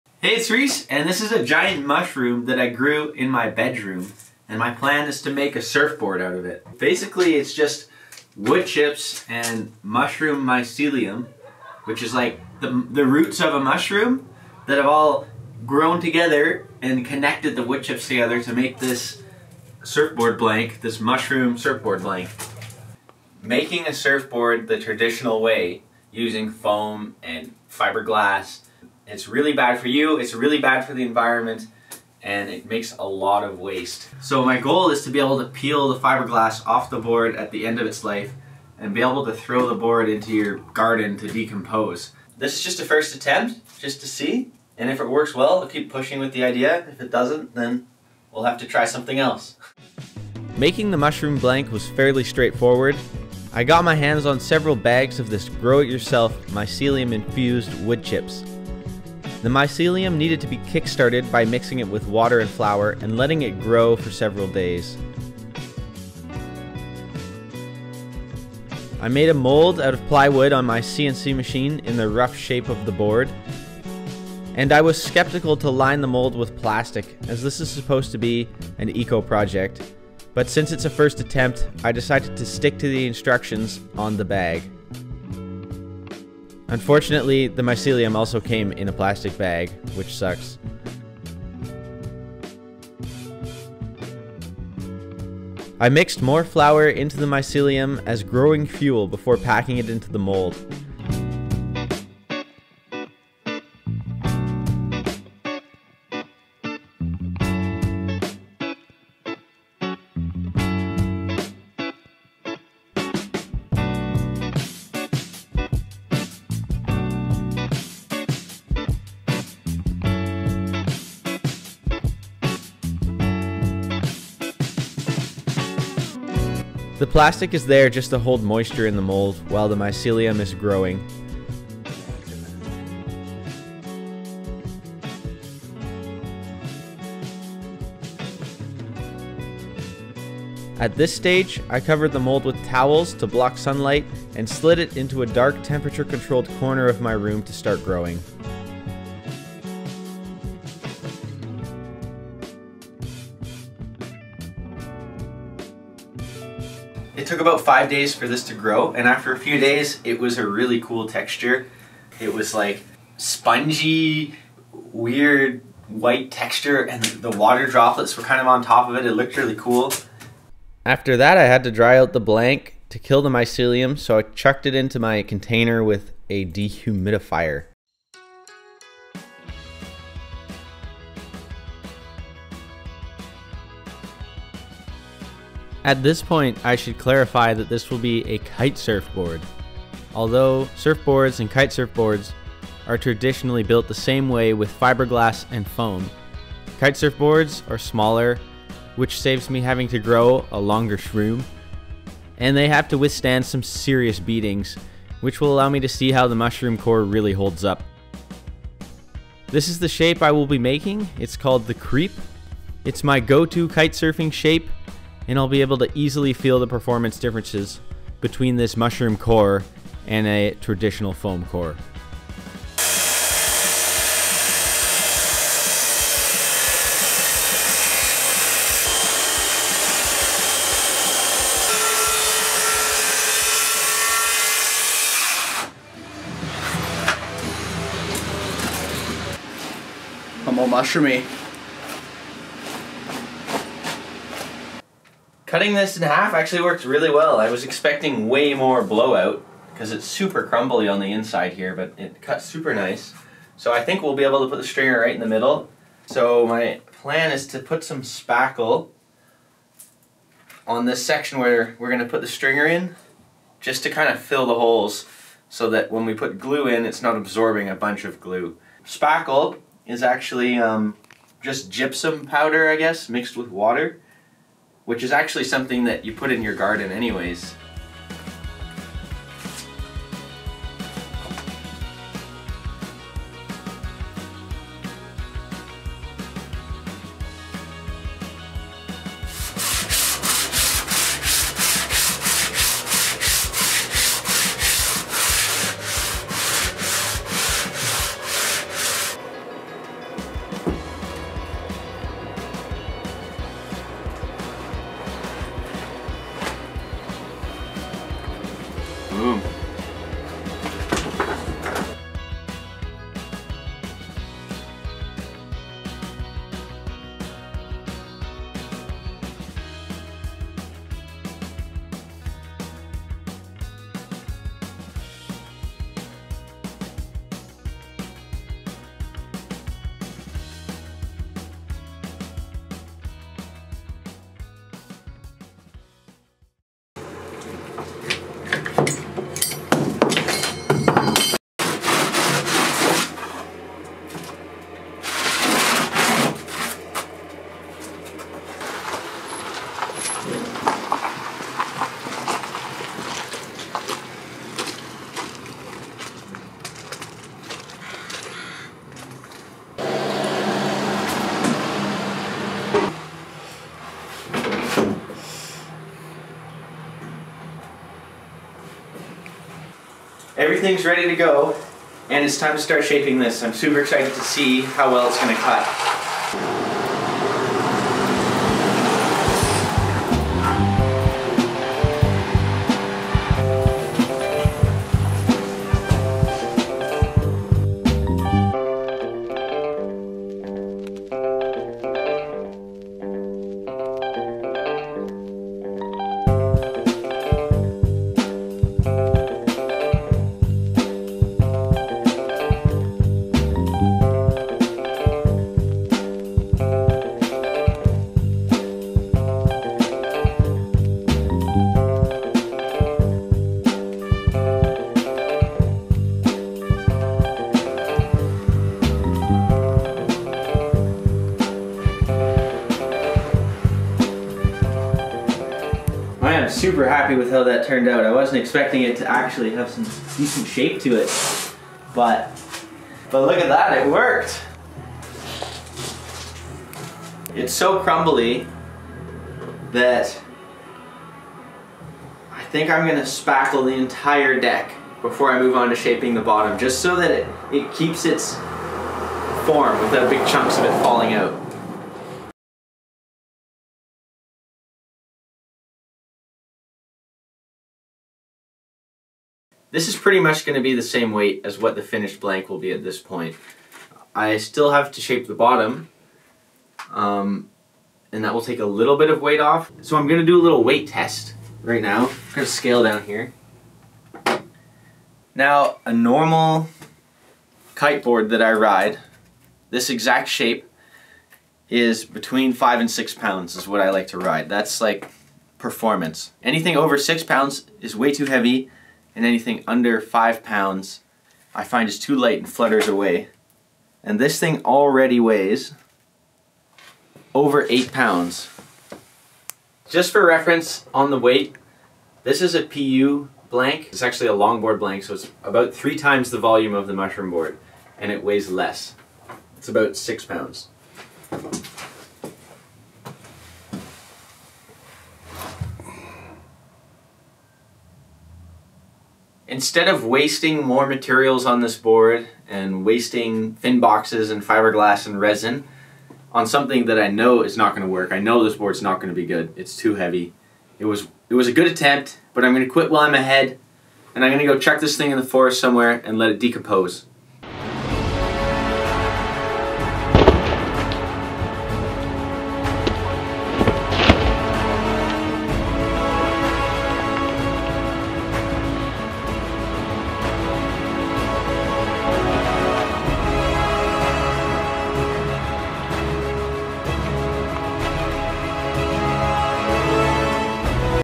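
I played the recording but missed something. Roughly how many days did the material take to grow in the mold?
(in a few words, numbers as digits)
5 days.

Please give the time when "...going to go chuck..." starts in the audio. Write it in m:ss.
8:54.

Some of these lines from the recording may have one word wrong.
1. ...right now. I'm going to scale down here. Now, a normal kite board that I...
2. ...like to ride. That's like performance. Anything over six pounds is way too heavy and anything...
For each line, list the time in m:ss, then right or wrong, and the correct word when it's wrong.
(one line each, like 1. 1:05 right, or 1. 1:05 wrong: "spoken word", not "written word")
1. 7:51 right
2. 8:03 right.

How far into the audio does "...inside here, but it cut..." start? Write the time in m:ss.
4:11.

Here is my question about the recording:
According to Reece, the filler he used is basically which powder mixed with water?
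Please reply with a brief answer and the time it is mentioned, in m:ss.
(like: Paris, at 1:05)
gypsum powder, at 4:31.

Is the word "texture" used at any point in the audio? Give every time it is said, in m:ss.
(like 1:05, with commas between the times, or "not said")
2:41, 2:46.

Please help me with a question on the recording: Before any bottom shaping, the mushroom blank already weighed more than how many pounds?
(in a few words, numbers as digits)
8 pounds.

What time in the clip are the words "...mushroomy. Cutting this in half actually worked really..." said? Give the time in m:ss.
4:00.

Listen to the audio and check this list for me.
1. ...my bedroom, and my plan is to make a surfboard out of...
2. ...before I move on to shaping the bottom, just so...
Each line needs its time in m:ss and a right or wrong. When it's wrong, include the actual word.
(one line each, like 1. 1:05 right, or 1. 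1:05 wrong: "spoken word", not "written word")
1. 0:03 right
2. 7:25 right.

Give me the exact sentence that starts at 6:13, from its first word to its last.
I'm super excited to see how well it's going to cut.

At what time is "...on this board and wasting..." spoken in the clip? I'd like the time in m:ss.
8:41.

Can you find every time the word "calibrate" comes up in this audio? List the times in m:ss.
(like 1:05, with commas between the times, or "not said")
not said.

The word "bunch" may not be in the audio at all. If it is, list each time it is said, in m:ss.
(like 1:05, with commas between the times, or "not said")
4:27.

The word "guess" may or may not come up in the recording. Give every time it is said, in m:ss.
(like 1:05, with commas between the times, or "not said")
4:32.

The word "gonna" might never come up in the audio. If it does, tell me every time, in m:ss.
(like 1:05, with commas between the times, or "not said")
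4:21, 7:22.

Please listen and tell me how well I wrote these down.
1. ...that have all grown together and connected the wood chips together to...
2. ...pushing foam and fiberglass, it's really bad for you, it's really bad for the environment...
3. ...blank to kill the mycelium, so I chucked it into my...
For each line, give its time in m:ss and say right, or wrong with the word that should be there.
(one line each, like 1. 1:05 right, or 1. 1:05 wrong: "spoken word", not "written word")
1. 0:14 right
2. 0:26 wrong: "using", not "pushing"
3. 2:52 right.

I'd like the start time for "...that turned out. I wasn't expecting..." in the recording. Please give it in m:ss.
7:07.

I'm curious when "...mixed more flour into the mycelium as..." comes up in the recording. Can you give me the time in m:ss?
1:35.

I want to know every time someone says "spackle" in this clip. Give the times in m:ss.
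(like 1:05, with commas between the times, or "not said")
4:18, 4:28, 7:23.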